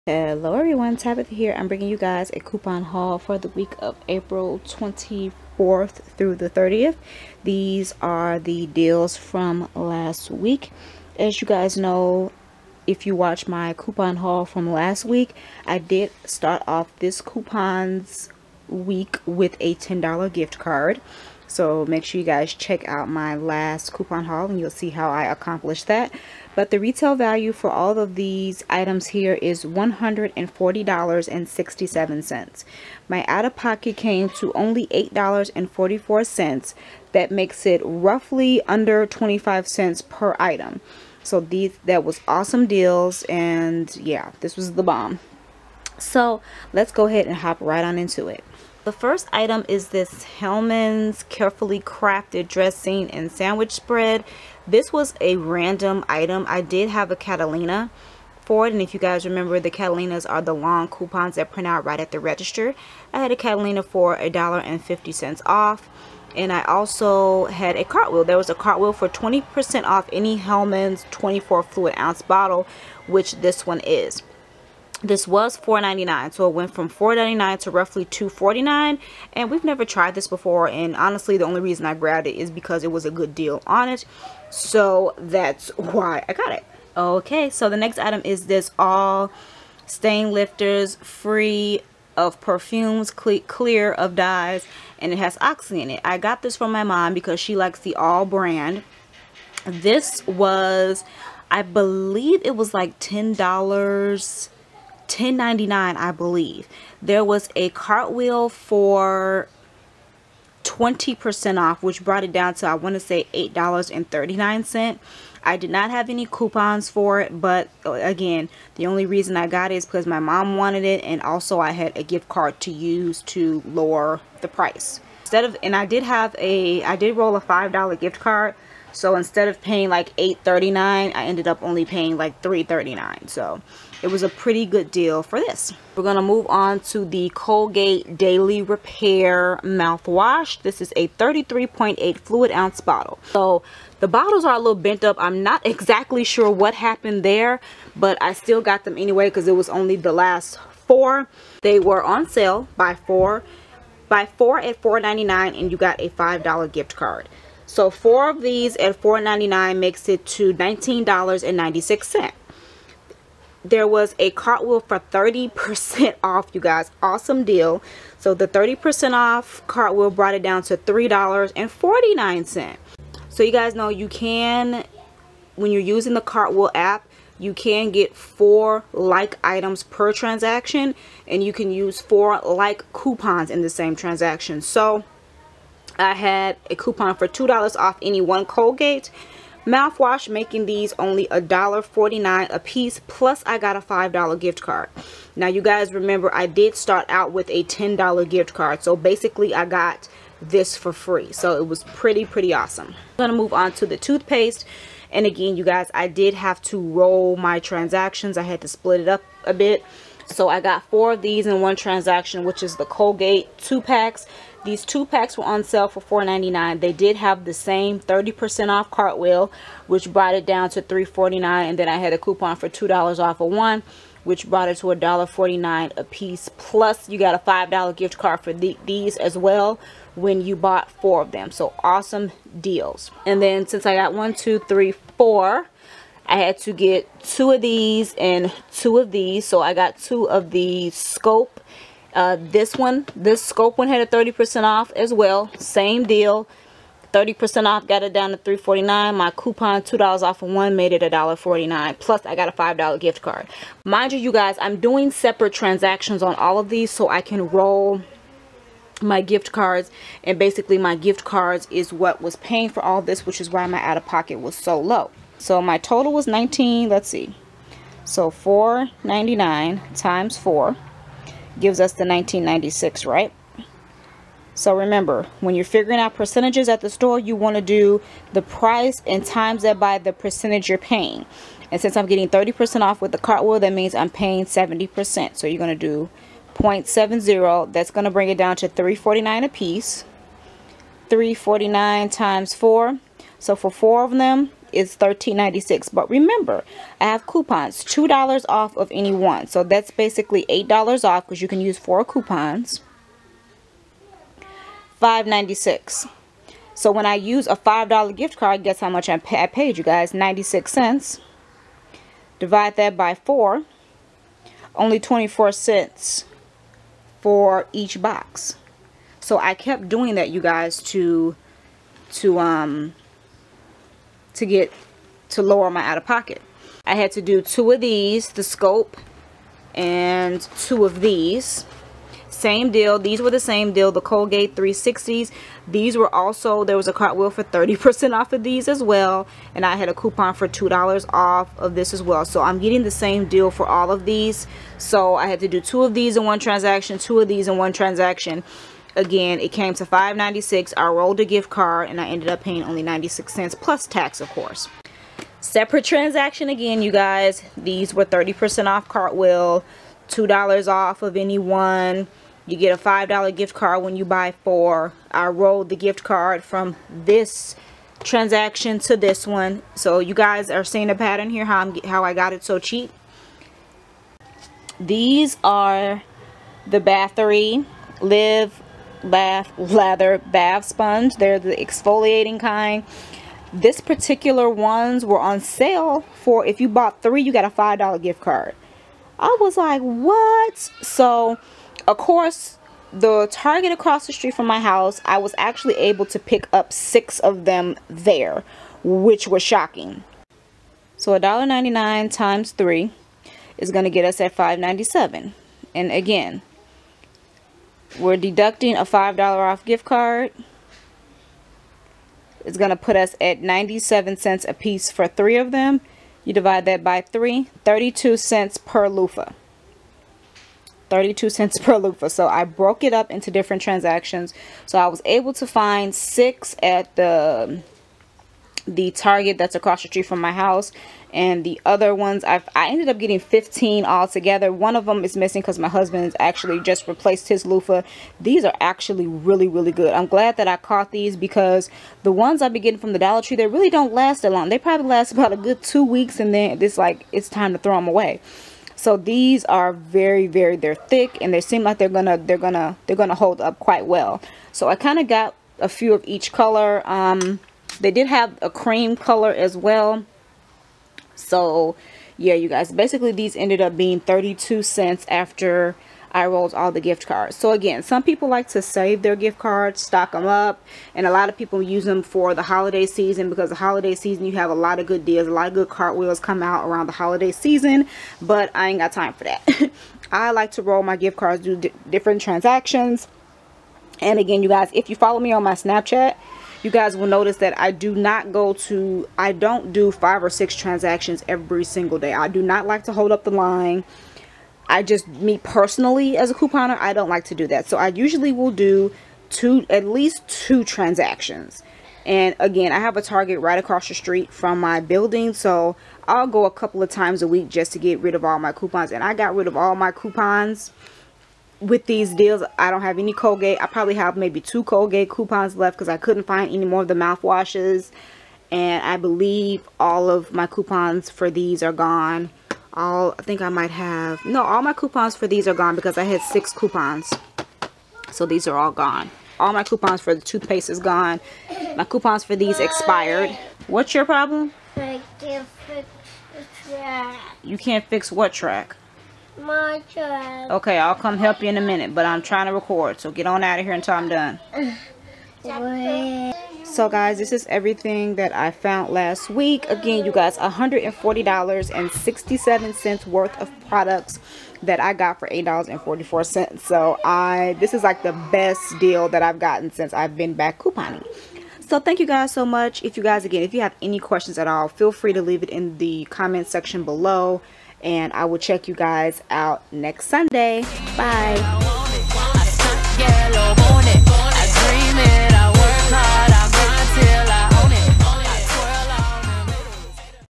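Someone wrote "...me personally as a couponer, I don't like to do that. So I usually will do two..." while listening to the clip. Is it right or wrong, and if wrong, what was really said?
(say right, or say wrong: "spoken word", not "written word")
right.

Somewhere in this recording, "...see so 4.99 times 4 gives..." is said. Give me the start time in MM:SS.
04:27.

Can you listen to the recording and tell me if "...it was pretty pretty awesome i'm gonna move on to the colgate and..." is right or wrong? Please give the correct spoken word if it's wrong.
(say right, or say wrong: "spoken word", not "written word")
wrong: "toothpaste", not "colgate".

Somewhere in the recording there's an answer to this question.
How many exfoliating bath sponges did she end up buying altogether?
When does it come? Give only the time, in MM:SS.
07:13.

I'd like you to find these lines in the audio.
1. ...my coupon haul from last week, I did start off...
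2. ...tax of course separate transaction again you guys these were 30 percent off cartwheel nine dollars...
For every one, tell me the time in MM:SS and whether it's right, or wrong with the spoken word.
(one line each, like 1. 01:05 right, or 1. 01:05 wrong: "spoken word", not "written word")
1. 00:13 right
2. 05:53 wrong: "two", not "nine".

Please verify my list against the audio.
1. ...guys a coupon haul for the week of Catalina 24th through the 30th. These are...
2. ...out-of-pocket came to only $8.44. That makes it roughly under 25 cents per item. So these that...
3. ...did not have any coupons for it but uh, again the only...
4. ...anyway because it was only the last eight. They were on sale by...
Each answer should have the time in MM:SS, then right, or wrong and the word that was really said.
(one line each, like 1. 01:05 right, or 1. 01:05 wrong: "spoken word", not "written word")
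1. 00:01 wrong: "April", not "Catalina"
2. 00:33 right
3. 01:55 right
4. 02:28 wrong: "four", not "eight".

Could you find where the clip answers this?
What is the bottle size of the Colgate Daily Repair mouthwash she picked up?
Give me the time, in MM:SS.
02:21.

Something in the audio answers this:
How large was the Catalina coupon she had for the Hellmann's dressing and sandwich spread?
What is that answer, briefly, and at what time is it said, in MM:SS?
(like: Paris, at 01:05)
$1.50, at 01:04.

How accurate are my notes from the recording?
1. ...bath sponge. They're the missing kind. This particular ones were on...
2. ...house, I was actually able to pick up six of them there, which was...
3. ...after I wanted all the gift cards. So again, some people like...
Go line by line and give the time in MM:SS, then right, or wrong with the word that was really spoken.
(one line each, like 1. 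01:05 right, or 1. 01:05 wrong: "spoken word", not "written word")
1. 06:20 wrong: "exfoliating", not "missing"
2. 06:34 right
3. 07:45 wrong: "rolled", not "wanted".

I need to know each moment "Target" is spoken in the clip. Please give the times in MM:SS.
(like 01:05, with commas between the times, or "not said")
06:33, 07:08, 08:23.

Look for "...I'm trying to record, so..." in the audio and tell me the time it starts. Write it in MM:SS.
09:02.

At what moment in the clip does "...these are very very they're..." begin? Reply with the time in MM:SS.
07:28.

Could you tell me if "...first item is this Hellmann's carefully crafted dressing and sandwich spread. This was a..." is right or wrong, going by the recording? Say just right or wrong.
right.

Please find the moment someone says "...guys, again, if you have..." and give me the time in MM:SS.
09:23.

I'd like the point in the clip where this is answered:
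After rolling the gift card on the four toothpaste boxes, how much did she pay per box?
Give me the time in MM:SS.
05:14.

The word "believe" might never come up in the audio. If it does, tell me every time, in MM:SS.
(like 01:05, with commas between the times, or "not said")
01:41, 01:46, 08:38.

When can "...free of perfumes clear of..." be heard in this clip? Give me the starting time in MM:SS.
01:30.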